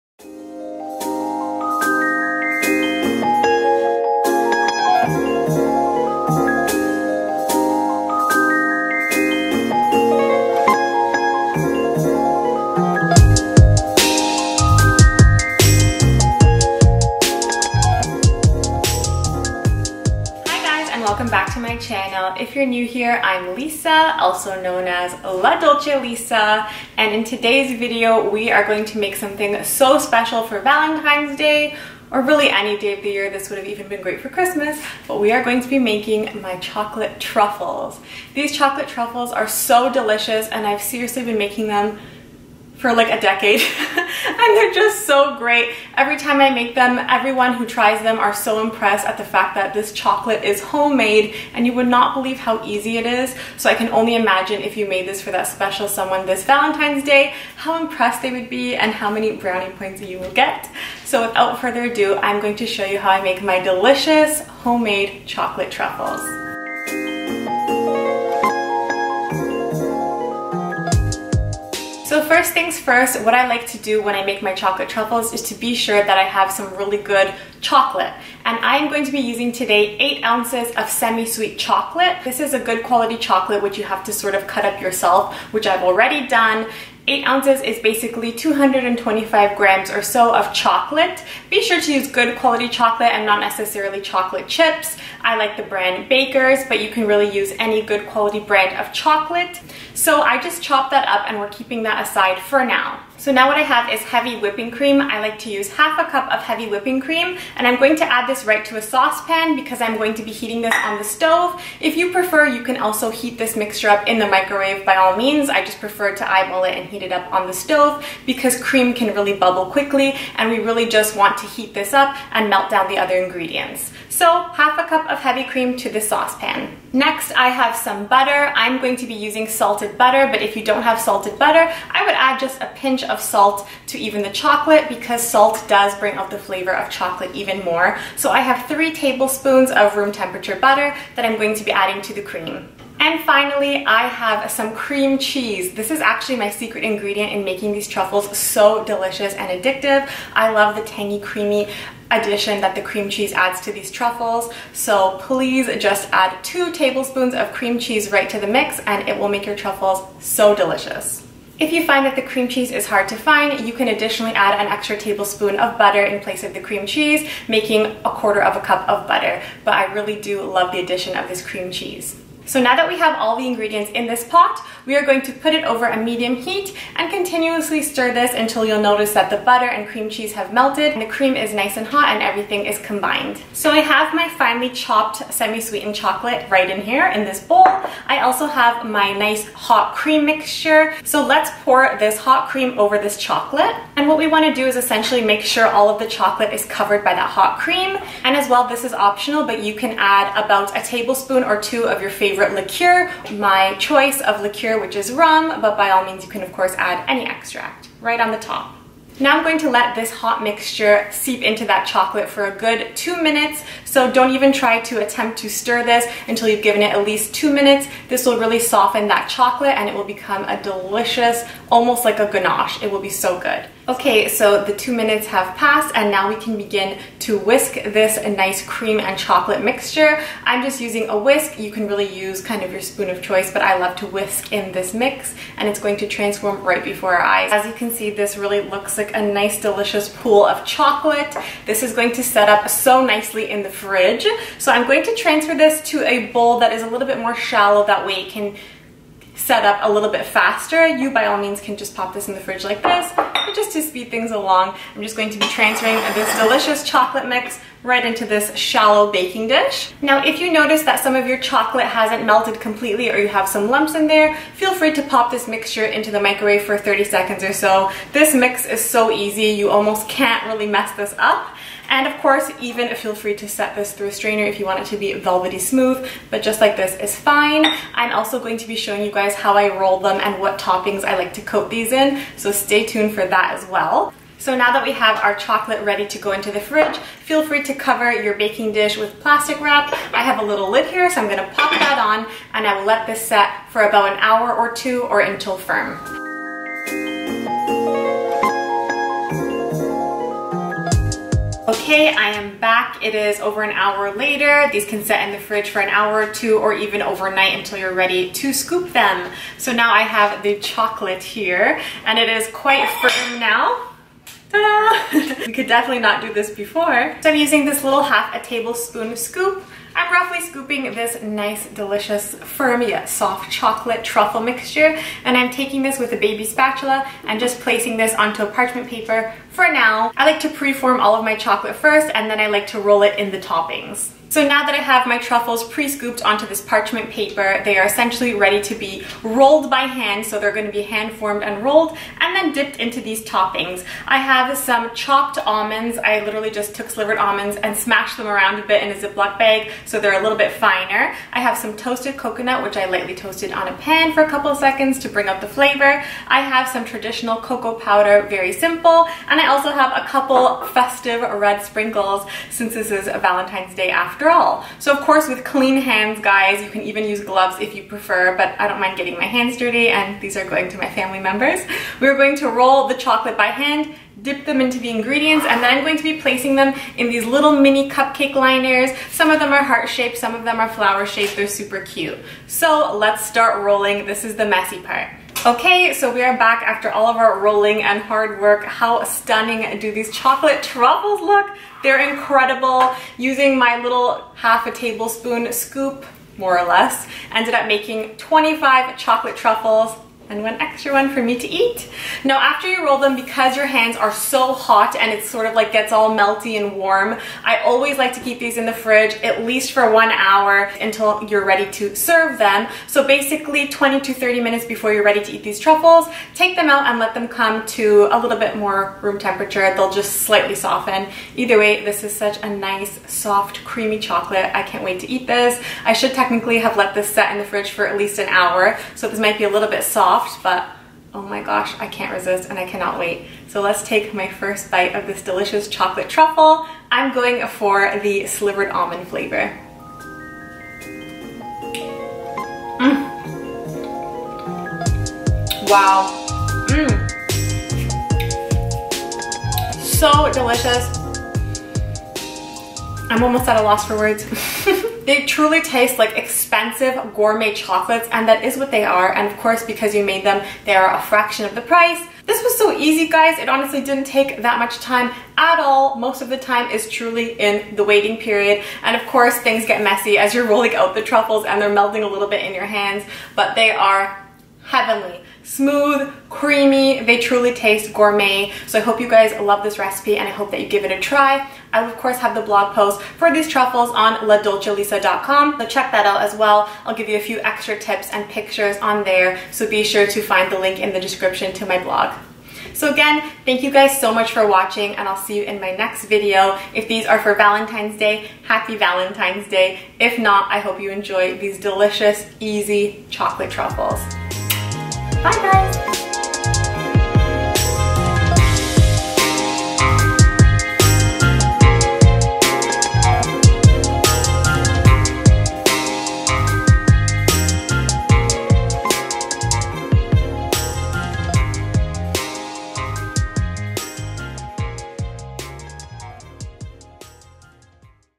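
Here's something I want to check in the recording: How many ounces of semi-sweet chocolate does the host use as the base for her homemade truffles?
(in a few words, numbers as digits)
8 ounces.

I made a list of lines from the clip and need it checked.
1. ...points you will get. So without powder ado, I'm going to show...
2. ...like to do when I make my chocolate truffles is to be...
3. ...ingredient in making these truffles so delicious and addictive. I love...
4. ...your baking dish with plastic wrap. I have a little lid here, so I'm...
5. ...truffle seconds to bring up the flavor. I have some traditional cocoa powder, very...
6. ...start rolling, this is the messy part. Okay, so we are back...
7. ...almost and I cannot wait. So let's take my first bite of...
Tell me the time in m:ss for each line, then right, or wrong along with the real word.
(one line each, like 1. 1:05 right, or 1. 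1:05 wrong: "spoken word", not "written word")
1. 0:59 wrong: "further", not "powder"
2. 1:13 right
3. 2:26 right
4. 4:48 right
5. 5:54 wrong: "couple", not "truffle"
6. 6:23 right
7. 7:12 wrong: "resist", not "almost".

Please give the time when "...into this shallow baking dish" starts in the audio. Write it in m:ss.
4:18.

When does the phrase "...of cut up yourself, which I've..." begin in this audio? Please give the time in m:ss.
1:24.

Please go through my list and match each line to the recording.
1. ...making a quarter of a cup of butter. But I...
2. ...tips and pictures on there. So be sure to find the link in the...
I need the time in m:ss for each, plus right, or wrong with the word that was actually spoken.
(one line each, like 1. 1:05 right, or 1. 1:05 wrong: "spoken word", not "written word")
1. 2:47 right
2. 8:07 right.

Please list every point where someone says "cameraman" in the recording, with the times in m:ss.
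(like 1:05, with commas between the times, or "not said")
not said.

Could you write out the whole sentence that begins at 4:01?
This is going to set up so nicely in the fridge.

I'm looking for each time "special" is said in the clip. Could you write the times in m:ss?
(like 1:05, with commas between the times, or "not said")
0:29, 0:55.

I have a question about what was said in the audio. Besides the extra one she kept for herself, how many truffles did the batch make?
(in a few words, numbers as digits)
25.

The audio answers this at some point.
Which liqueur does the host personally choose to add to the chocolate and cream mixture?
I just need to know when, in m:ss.
3:25.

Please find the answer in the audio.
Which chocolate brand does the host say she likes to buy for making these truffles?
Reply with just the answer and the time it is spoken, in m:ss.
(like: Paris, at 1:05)
Baker's, at 1:36.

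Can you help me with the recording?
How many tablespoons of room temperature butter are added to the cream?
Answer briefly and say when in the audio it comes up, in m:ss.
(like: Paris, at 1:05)
3, at 2:18.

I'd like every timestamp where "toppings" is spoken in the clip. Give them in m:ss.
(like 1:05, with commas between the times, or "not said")
4:40, 5:33, 5:43.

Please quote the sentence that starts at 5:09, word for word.
So now I have the chocolate here and it is quite firm now.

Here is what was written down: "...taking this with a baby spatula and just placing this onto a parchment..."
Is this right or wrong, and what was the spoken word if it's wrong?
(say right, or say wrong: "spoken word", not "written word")
right.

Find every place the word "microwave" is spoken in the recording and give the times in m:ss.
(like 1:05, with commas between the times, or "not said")
1:54, 4:26.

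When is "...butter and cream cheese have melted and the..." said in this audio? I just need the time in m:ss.
2:59.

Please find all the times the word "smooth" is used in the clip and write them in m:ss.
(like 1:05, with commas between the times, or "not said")
4:35, 7:55.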